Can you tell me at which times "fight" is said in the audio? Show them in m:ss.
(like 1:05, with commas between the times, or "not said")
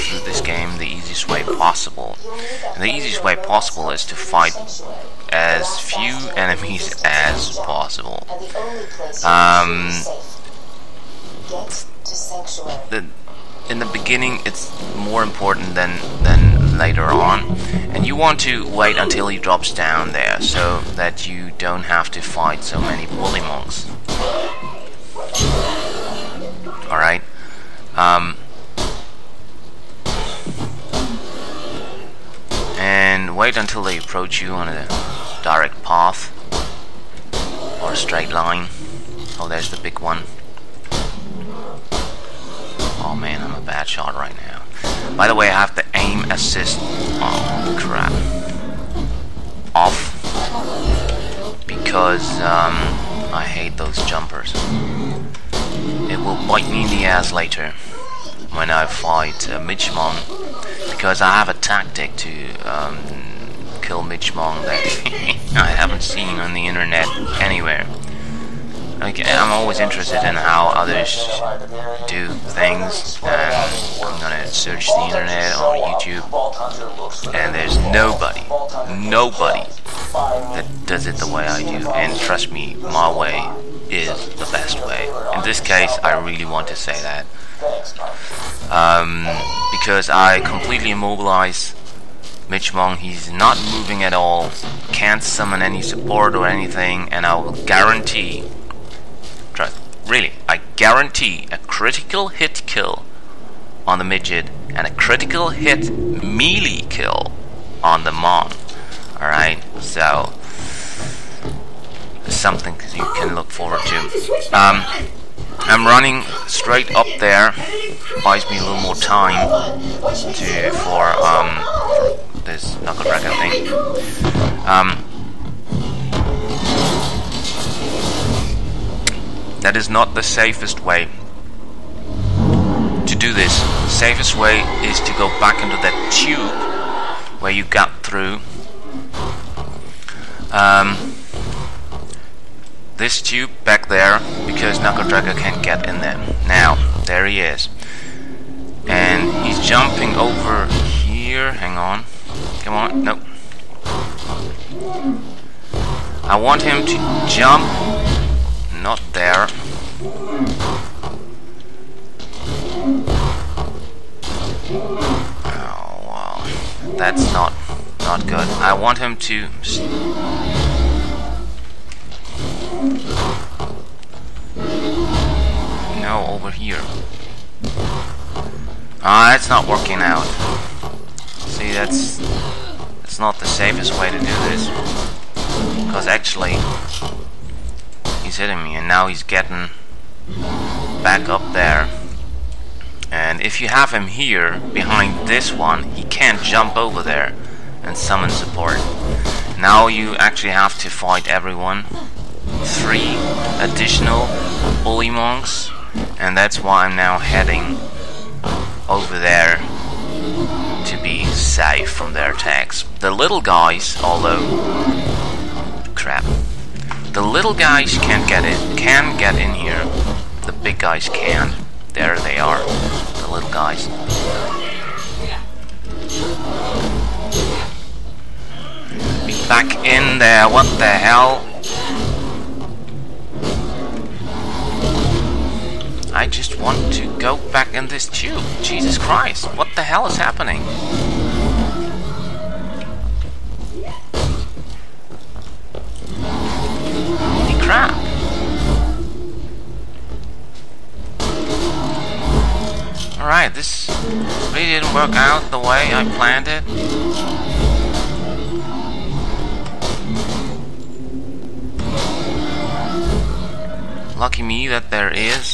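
0:04, 0:22, 0:58, 3:20.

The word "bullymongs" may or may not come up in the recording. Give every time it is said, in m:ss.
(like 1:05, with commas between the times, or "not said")
0:23, 3:24.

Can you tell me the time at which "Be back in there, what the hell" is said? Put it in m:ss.
3:49.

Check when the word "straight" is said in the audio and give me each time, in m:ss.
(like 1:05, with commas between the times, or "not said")
0:37, 1:56.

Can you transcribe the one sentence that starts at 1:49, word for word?
Alright, so something you can look forward to.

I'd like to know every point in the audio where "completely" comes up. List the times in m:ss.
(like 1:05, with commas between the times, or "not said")
1:30.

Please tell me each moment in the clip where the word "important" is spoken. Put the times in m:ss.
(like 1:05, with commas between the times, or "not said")
0:15.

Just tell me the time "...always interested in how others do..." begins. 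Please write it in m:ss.
1:09.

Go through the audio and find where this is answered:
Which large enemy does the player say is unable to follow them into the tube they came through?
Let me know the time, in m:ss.
2:24.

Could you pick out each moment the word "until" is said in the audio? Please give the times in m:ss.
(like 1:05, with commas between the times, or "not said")
0:18, 0:33.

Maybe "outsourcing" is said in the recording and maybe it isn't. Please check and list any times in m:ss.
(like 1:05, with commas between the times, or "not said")
not said.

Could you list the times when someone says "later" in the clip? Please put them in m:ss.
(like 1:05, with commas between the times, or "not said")
0:16, 0:57.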